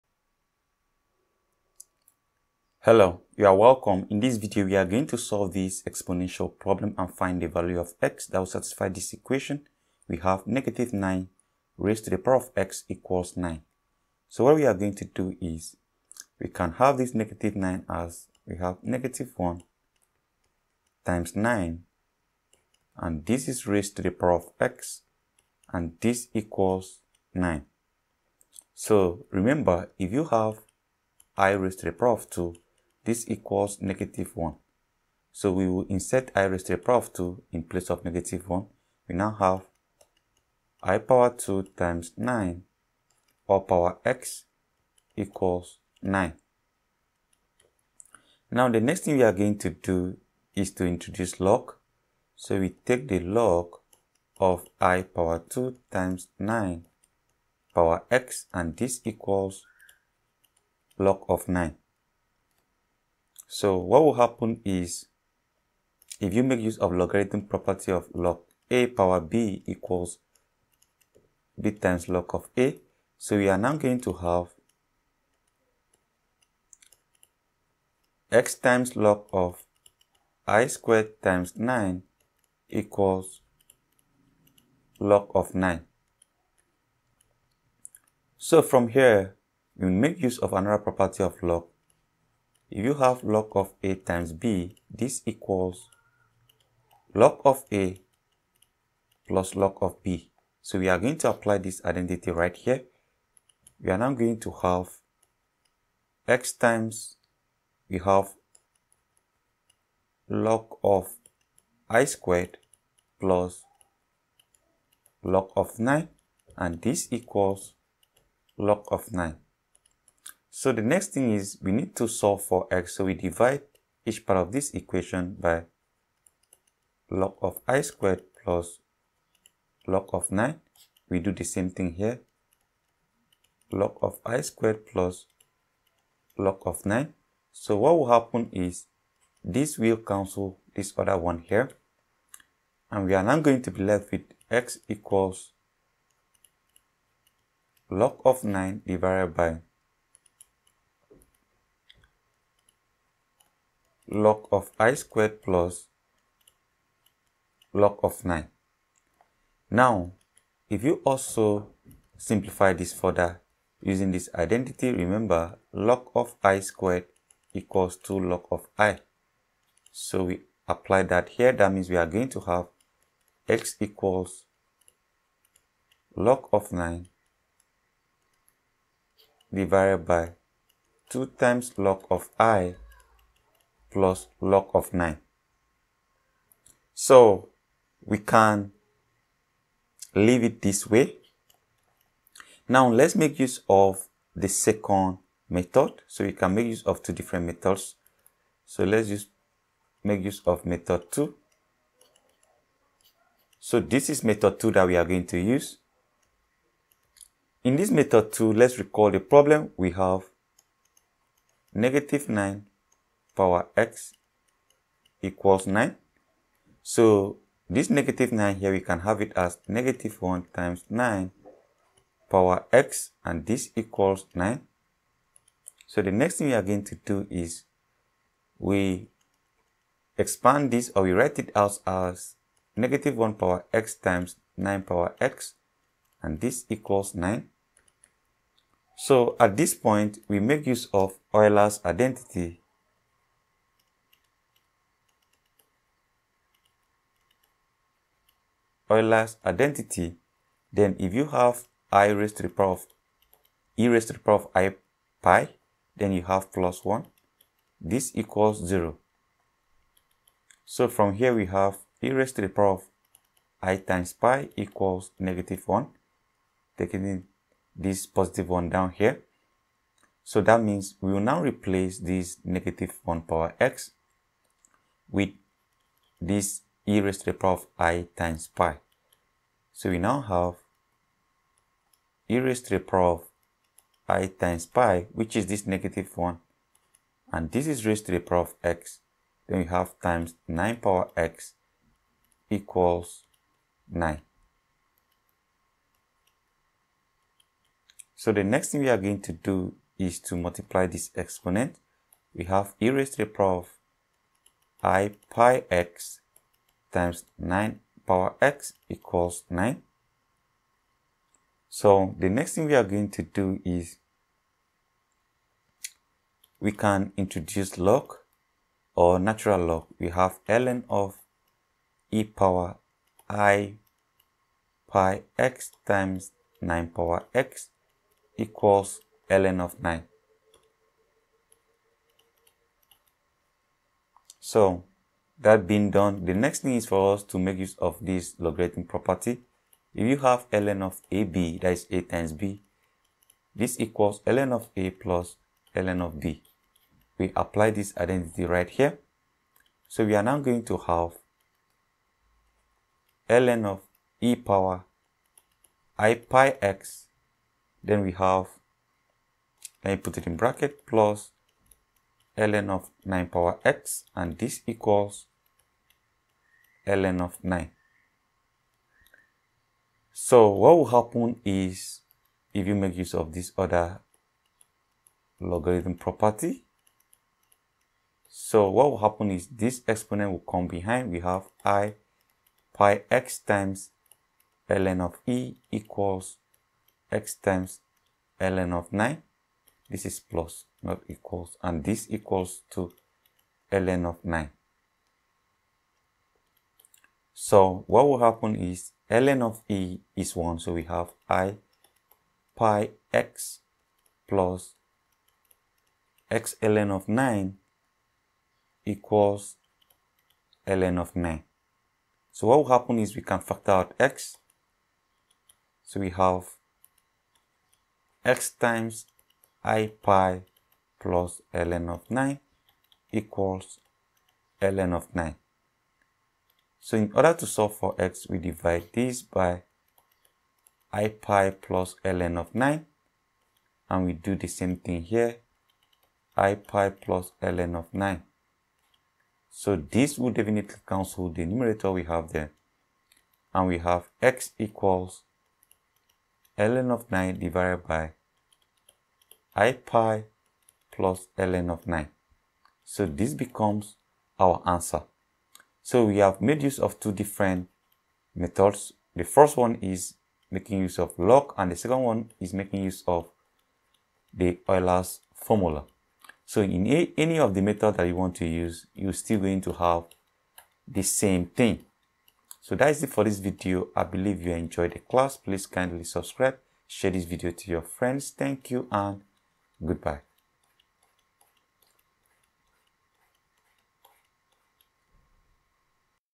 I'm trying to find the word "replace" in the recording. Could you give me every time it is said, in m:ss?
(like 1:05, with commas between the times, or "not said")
4:31.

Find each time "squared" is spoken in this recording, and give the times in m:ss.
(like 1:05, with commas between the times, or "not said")
1:20, 1:52, 2:07, 2:14, 2:34, 2:46.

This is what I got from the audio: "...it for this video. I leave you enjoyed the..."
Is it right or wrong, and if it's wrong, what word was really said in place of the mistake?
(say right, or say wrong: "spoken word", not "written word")
wrong: "believe", not "leave".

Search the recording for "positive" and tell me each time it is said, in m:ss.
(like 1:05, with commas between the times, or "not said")
4:28.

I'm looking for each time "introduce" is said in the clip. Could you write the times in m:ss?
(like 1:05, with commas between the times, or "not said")
0:50, 5:17.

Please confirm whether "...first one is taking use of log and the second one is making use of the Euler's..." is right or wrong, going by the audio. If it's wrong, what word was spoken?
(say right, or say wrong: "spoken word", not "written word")
wrong: "making", not "taking".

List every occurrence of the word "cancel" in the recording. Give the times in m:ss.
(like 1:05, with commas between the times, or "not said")
2:19, 7:20.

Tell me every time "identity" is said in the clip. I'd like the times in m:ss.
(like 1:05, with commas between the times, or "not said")
1:41, 2:44, 4:01, 4:09, 5:47.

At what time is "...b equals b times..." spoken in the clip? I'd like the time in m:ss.
1:09.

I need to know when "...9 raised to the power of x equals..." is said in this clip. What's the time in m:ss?
0:10.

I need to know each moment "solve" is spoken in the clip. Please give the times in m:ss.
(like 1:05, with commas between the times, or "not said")
0:05, 2:02, 7:07.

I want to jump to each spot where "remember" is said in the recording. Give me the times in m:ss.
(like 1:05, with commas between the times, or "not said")
0:29, 2:44.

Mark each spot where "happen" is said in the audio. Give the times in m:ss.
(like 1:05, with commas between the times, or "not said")
1:04, 2:18, 6:10, 6:18, 6:38, 6:52.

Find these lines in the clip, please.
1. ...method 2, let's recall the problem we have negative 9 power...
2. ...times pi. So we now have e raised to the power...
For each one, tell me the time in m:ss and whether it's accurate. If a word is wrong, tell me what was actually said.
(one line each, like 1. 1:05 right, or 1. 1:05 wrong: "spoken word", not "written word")
1. 3:27 right
2. 4:38 right.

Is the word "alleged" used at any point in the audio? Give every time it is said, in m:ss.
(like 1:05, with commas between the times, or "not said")
not said.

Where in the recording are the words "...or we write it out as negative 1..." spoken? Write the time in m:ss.
3:50.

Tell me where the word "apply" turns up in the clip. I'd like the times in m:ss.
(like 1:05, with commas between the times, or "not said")
1:41, 2:50, 5:47.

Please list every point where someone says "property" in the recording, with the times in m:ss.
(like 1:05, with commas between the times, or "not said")
1:07, 1:30, 5:38, 6:15.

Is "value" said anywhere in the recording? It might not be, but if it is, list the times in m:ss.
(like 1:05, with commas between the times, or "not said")
0:07.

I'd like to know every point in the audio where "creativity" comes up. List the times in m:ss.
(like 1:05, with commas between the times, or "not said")
not said.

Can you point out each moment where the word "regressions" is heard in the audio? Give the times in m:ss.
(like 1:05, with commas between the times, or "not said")
not said.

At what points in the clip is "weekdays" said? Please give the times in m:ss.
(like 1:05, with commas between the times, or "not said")
not said.